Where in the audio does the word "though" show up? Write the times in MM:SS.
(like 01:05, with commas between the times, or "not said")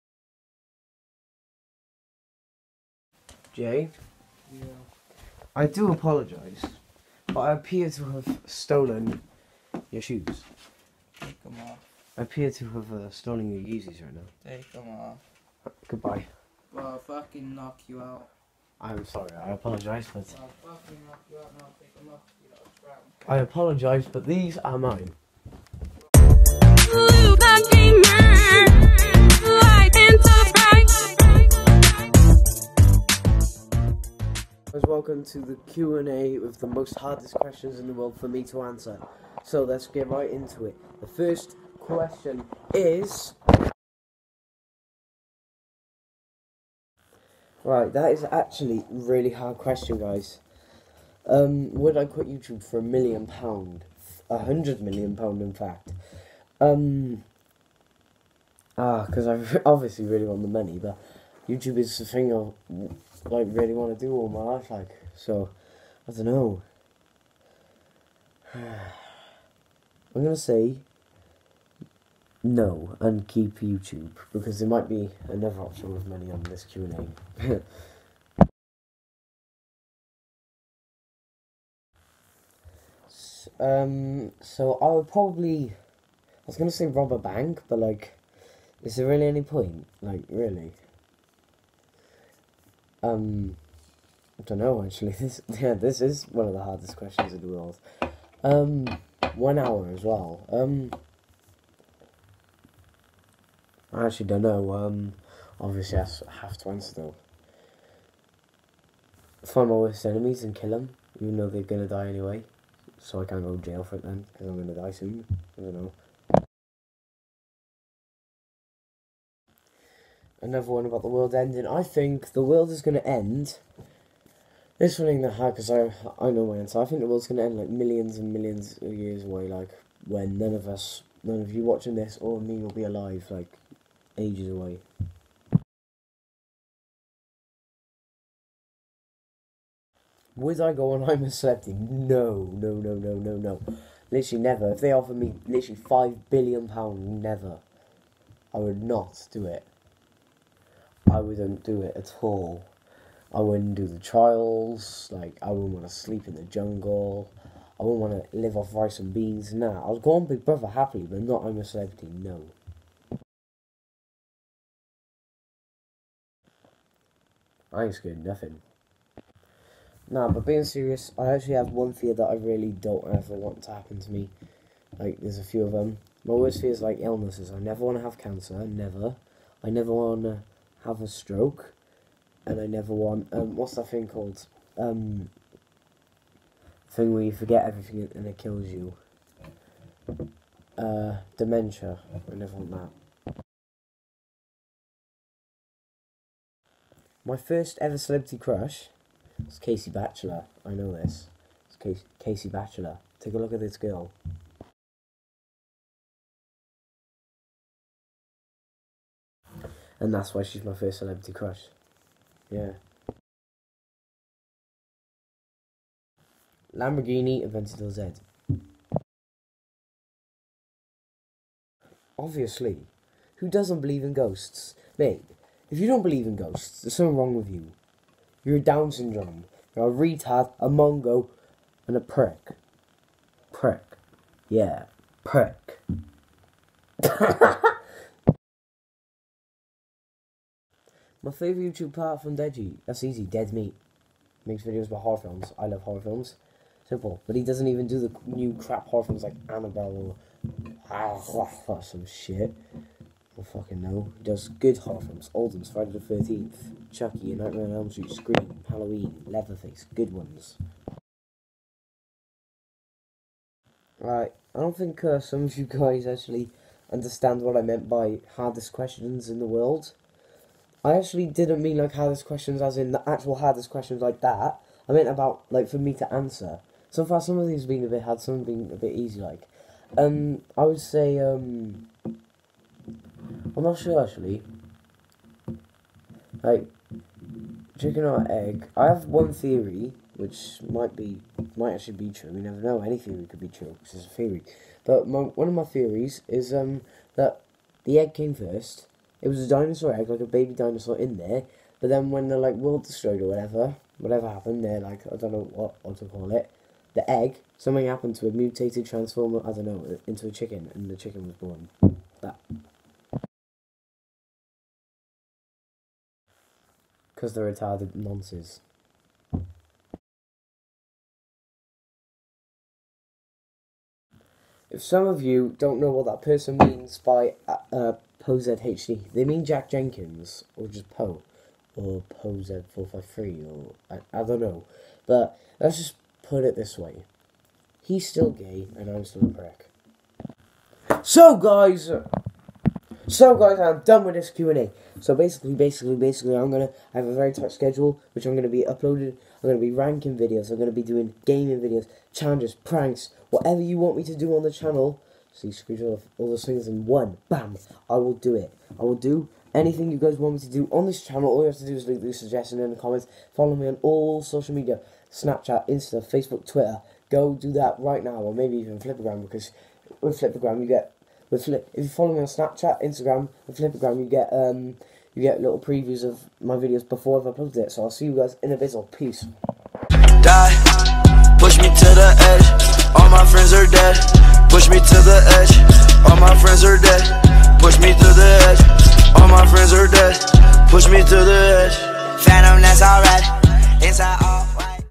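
01:46, 01:51.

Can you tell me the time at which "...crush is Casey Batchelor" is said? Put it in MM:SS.
03:18.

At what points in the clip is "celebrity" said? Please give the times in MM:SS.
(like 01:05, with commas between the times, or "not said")
02:21, 02:41, 03:17, 03:30.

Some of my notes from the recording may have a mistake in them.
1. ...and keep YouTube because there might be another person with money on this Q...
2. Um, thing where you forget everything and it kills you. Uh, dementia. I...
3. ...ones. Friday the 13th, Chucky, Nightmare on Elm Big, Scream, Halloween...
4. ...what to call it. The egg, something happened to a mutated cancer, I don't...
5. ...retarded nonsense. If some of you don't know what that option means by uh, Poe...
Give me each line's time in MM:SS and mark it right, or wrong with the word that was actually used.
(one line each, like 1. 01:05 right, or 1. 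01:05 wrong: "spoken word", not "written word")
1. 01:12 wrong: "option", not "person"
2. 03:04 right
3. 04:15 wrong: "Street", not "Big"
4. 05:05 wrong: "transformer", not "cancer"
5. 05:17 wrong: "person", not "option".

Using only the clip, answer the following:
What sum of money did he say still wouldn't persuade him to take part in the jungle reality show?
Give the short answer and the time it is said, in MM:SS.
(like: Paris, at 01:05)
5 billion pounds, at 02:25.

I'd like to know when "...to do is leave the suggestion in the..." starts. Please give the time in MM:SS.
06:01.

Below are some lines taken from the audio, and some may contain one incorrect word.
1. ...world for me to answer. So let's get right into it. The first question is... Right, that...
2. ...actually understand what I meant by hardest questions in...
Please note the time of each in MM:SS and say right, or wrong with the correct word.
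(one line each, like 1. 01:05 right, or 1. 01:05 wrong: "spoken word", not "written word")
1. 00:37 right
2. 04:26 right.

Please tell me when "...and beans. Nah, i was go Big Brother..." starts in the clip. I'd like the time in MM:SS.
02:38.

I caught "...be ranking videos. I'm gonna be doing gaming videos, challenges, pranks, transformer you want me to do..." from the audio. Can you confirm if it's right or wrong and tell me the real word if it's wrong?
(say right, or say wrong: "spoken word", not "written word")
wrong: "whatever", not "transformer".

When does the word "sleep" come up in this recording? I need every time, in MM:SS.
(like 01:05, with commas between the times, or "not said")
02:35.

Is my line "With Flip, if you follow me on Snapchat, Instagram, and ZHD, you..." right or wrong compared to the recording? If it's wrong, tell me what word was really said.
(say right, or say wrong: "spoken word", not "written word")
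wrong: "Flipagram", not "ZHD".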